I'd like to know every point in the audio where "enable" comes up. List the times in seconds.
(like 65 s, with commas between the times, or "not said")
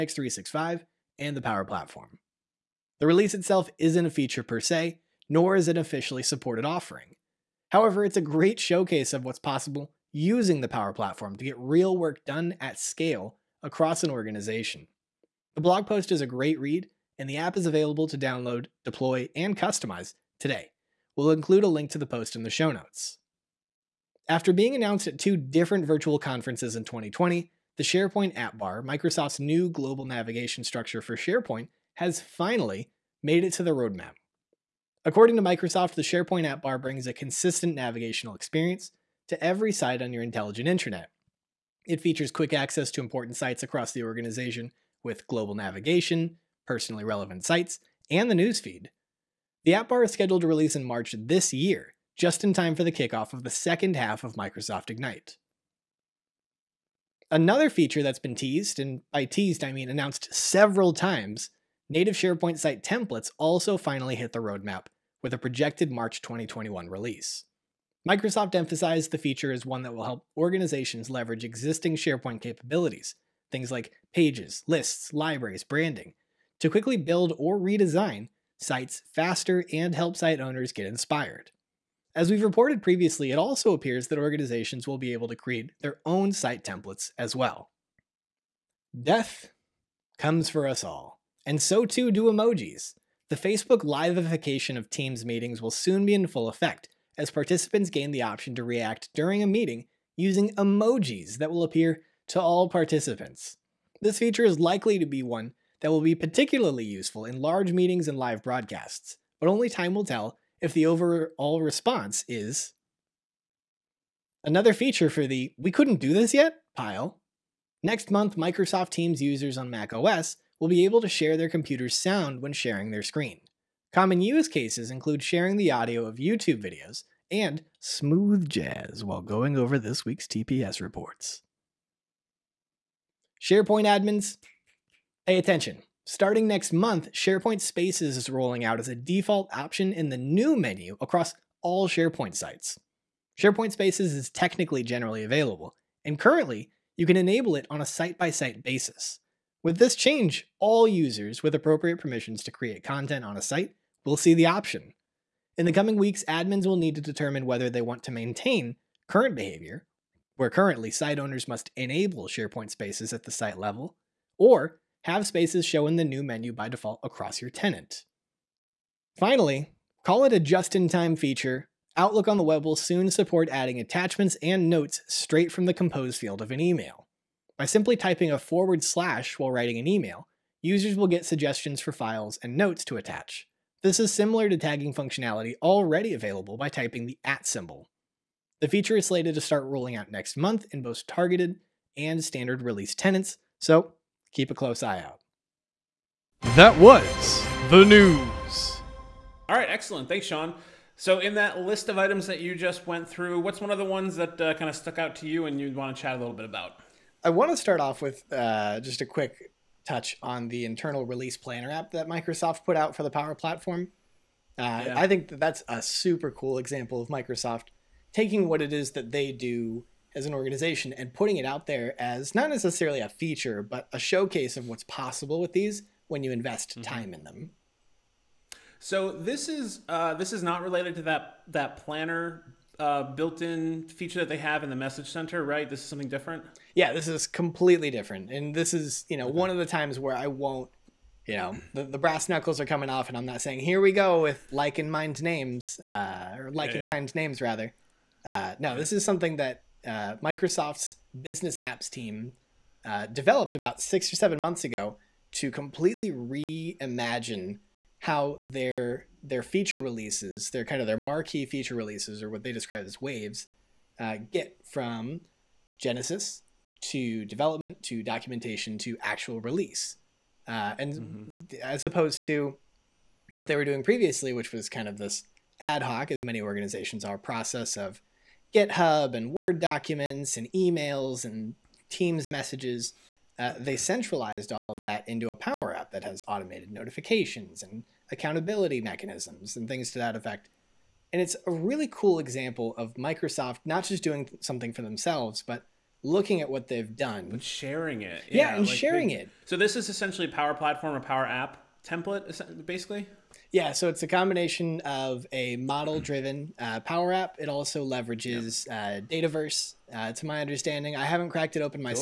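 147 s, 161 s.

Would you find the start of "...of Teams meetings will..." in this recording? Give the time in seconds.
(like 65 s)
94 s.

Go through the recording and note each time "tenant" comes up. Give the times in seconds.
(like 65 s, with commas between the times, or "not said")
167 s, 192 s.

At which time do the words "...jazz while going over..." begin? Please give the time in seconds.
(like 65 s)
128 s.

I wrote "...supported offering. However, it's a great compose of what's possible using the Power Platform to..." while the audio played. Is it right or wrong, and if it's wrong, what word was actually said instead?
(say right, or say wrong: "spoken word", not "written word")
wrong: "showcase", not "compose".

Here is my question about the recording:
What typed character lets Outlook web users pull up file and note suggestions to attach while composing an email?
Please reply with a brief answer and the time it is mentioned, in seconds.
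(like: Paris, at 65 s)
forward slash, at 178 s.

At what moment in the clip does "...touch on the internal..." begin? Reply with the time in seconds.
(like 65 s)
209 s.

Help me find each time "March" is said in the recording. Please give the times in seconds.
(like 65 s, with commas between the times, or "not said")
50 s, 65 s.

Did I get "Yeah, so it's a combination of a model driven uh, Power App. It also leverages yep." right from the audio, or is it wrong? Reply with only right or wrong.
right.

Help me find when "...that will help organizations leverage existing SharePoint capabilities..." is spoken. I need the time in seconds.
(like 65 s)
69 s.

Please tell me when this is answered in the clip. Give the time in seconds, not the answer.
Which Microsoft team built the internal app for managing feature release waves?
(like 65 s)
251 s.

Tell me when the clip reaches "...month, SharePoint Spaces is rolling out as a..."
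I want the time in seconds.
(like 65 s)
136 s.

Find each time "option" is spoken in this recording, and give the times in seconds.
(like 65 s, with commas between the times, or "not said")
98 s, 139 s, 154 s.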